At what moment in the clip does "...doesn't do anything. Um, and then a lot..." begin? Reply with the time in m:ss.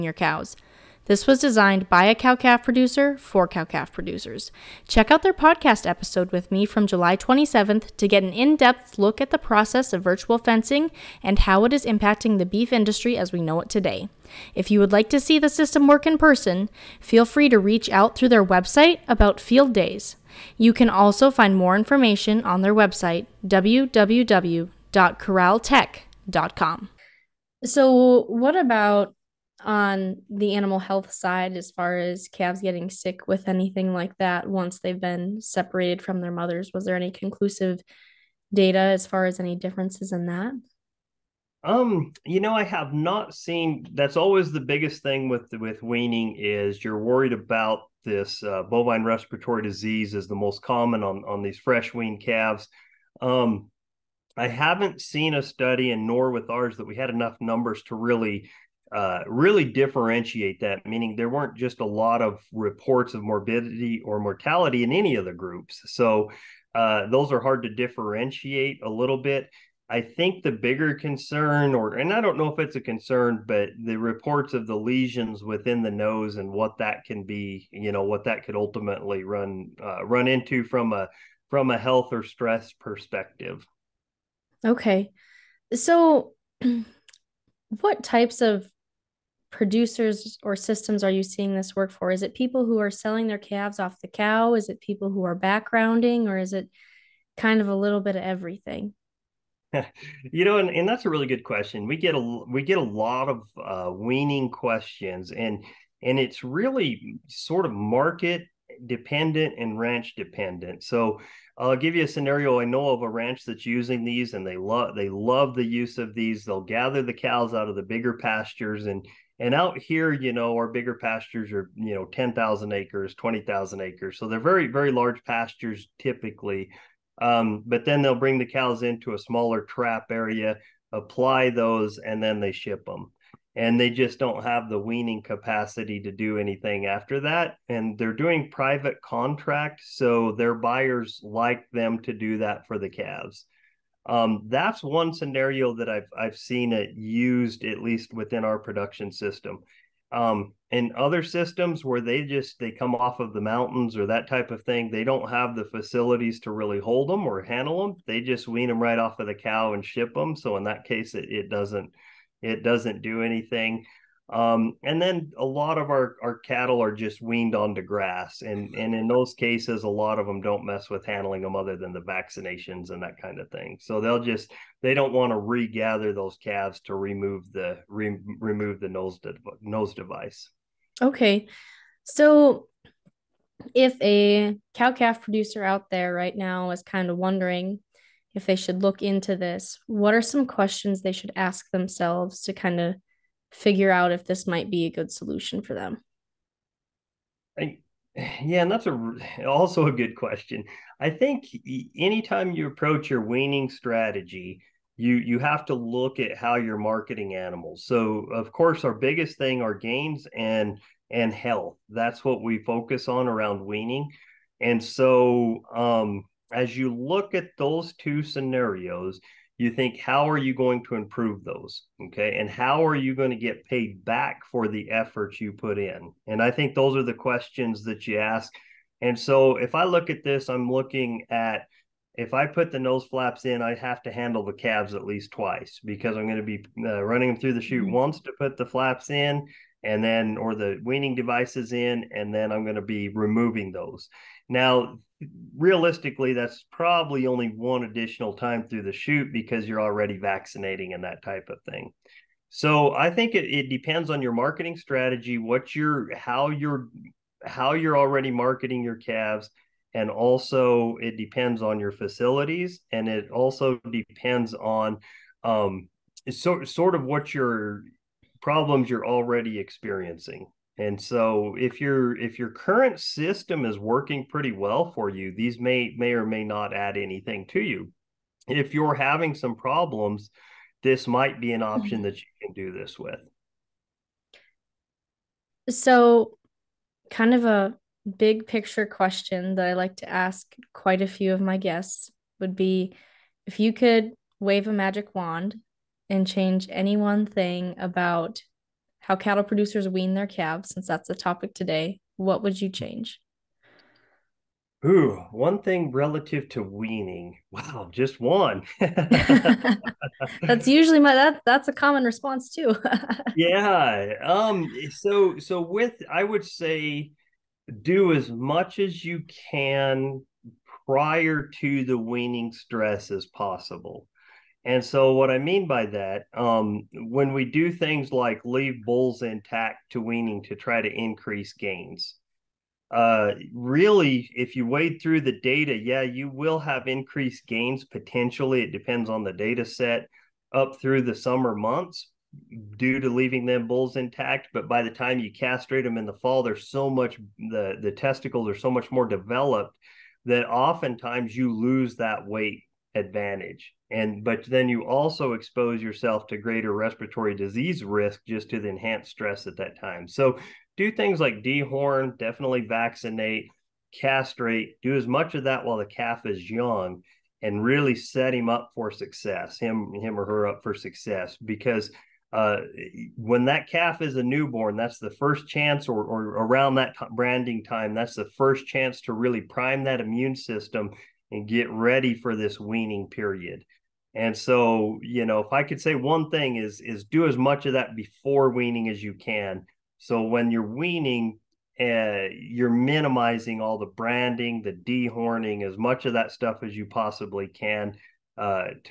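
2:42.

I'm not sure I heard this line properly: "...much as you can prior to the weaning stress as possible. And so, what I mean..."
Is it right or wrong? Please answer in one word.
right.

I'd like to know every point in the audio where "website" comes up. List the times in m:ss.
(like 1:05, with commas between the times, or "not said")
0:18, 0:22.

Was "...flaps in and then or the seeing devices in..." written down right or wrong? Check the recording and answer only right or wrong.
wrong.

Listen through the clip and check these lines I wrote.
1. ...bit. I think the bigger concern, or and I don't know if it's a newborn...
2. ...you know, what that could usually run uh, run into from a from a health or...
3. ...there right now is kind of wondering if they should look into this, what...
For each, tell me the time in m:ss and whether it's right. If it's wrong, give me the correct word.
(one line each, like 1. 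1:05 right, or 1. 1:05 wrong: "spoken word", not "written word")
1. 1:09 wrong: "concern", not "newborn"
2. 1:17 wrong: "ultimately", not "usually"
3. 3:05 right.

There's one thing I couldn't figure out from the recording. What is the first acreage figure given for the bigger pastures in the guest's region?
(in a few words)
10,000 acres.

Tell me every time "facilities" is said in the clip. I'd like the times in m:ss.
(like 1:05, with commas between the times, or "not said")
2:35, 4:21.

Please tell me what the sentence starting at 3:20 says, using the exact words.
I think anytime you approach your weaning strategy, you you have to look at how you're marketing animals.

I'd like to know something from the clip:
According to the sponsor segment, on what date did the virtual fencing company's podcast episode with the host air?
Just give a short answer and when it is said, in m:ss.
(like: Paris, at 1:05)
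July 27th, at 0:06.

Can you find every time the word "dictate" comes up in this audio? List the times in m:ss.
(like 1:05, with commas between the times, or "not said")
not said.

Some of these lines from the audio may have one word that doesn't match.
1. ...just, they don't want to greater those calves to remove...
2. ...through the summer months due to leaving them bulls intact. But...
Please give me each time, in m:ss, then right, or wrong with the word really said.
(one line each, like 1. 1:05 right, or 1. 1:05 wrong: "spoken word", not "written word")
1. 2:54 wrong: "regather", not "greater"
2. 5:40 right.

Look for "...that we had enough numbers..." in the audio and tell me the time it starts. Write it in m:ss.
0:56.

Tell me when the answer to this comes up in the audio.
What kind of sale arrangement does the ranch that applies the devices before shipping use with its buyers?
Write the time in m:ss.
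2:18.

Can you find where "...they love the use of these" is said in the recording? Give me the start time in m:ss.
1:54.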